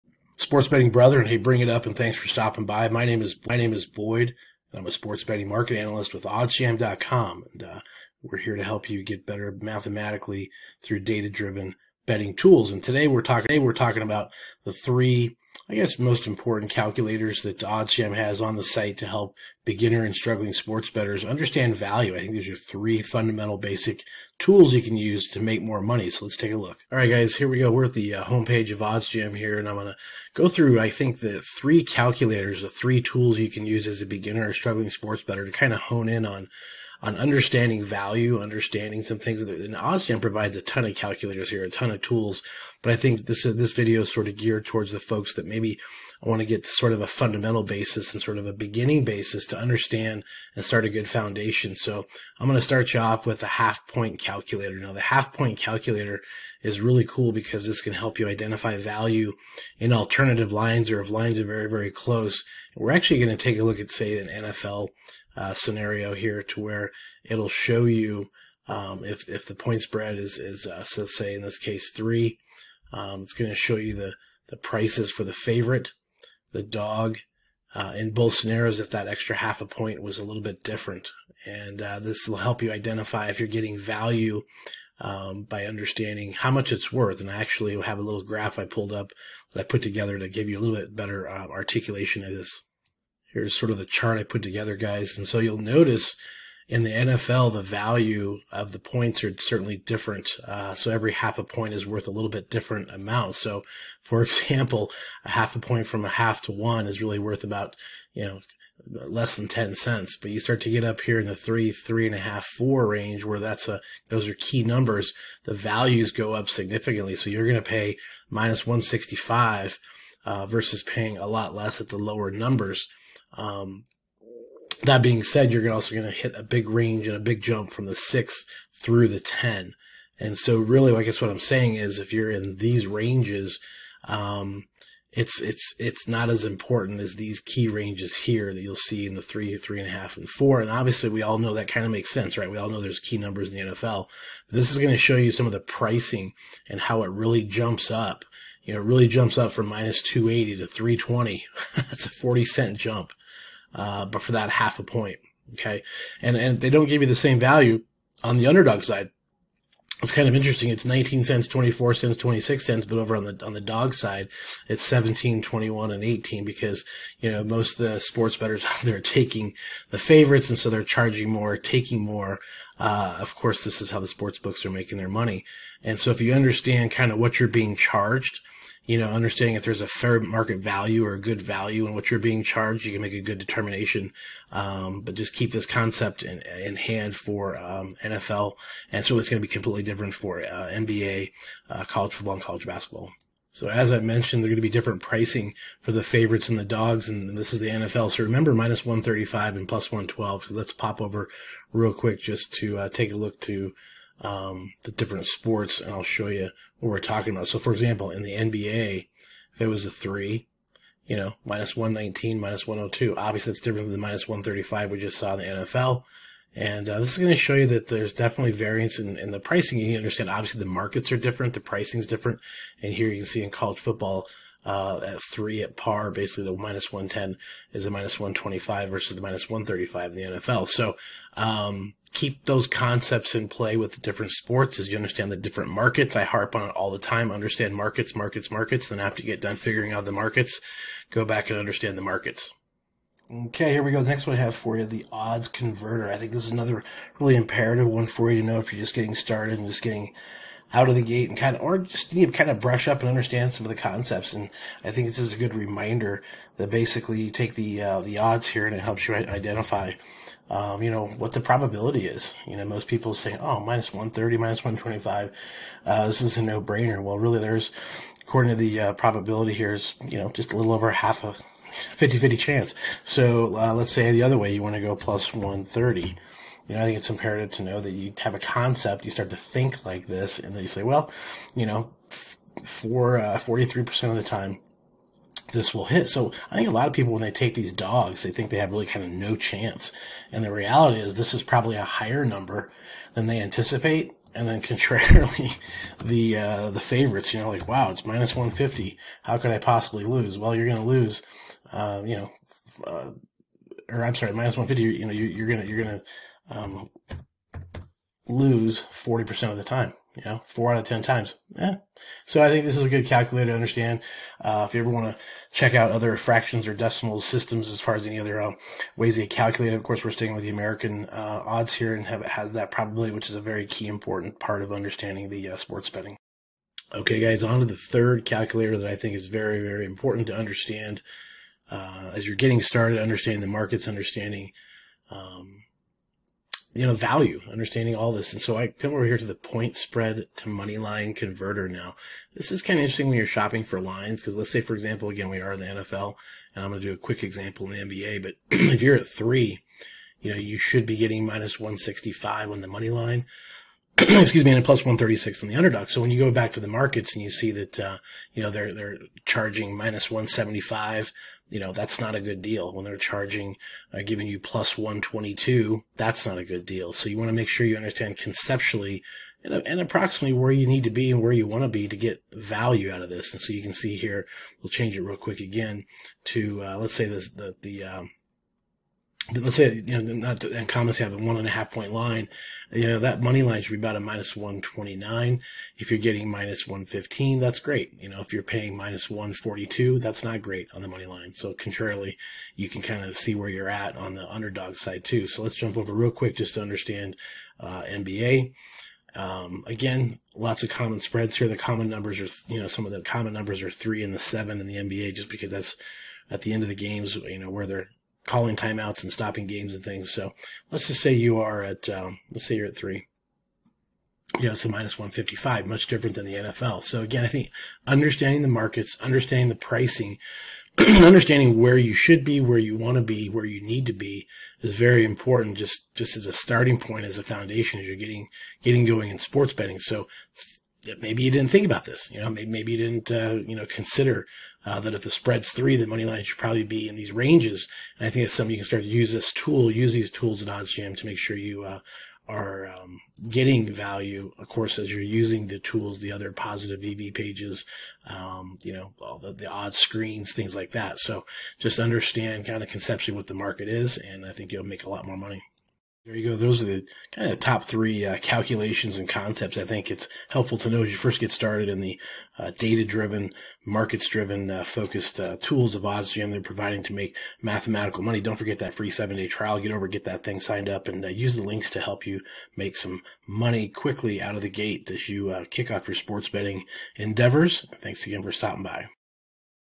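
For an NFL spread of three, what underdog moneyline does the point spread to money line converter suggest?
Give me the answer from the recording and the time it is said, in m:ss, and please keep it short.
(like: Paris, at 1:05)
+136, at 5:54.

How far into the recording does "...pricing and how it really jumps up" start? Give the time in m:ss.
2:25.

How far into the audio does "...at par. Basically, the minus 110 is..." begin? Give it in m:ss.
3:45.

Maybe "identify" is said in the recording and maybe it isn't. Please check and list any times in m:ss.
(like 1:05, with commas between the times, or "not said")
0:58, 1:22, 4:19.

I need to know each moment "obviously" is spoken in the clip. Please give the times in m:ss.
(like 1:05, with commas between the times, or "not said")
2:20, 3:33, 3:40.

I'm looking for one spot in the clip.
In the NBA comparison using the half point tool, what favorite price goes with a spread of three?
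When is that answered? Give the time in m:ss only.
3:31.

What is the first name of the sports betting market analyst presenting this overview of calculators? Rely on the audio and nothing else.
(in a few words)
Boyd.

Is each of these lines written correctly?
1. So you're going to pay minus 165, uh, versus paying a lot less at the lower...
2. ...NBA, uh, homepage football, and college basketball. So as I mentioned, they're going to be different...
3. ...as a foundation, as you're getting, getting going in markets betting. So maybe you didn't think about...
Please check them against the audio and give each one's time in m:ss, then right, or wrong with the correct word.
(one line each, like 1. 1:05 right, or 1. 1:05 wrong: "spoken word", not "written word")
1. 1:57 right
2. 3:10 wrong: "college", not "homepage"
3. 7:07 wrong: "sports", not "markets".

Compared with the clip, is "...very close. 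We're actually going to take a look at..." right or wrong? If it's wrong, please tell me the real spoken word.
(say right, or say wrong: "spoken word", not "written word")
right.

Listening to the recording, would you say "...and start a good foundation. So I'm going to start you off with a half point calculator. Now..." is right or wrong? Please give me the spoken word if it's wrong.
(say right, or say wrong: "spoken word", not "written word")
right.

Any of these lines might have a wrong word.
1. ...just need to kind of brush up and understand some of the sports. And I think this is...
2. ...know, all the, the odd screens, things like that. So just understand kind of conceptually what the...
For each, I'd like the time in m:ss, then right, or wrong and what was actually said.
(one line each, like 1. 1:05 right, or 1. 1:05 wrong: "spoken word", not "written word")
1. 4:11 wrong: "concepts", not "sports"
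2. 7:28 right.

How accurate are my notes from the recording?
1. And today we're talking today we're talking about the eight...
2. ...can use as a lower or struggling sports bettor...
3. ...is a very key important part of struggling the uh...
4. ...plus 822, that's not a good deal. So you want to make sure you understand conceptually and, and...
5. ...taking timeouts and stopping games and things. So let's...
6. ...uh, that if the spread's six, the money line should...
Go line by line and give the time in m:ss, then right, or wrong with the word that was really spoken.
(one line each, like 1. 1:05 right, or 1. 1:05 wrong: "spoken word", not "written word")
1. 0:12 wrong: "three", not "eight"
2. 0:33 wrong: "beginner", not "lower"
3. 5:23 wrong: "understanding", not "struggling"
4. 6:04 wrong: "122", not "822"
5. 6:48 wrong: "calling", not "taking"
6. 7:14 wrong: "three", not "six".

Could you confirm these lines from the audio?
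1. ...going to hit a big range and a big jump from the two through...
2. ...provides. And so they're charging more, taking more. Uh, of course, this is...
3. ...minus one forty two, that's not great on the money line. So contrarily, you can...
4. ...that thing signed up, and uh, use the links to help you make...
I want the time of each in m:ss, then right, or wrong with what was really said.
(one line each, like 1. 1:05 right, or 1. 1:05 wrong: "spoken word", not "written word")
1. 2:05 wrong: "six", not "two"
2. 2:49 wrong: "favorites", not "provides"
3. 6:28 right
4. 7:50 right.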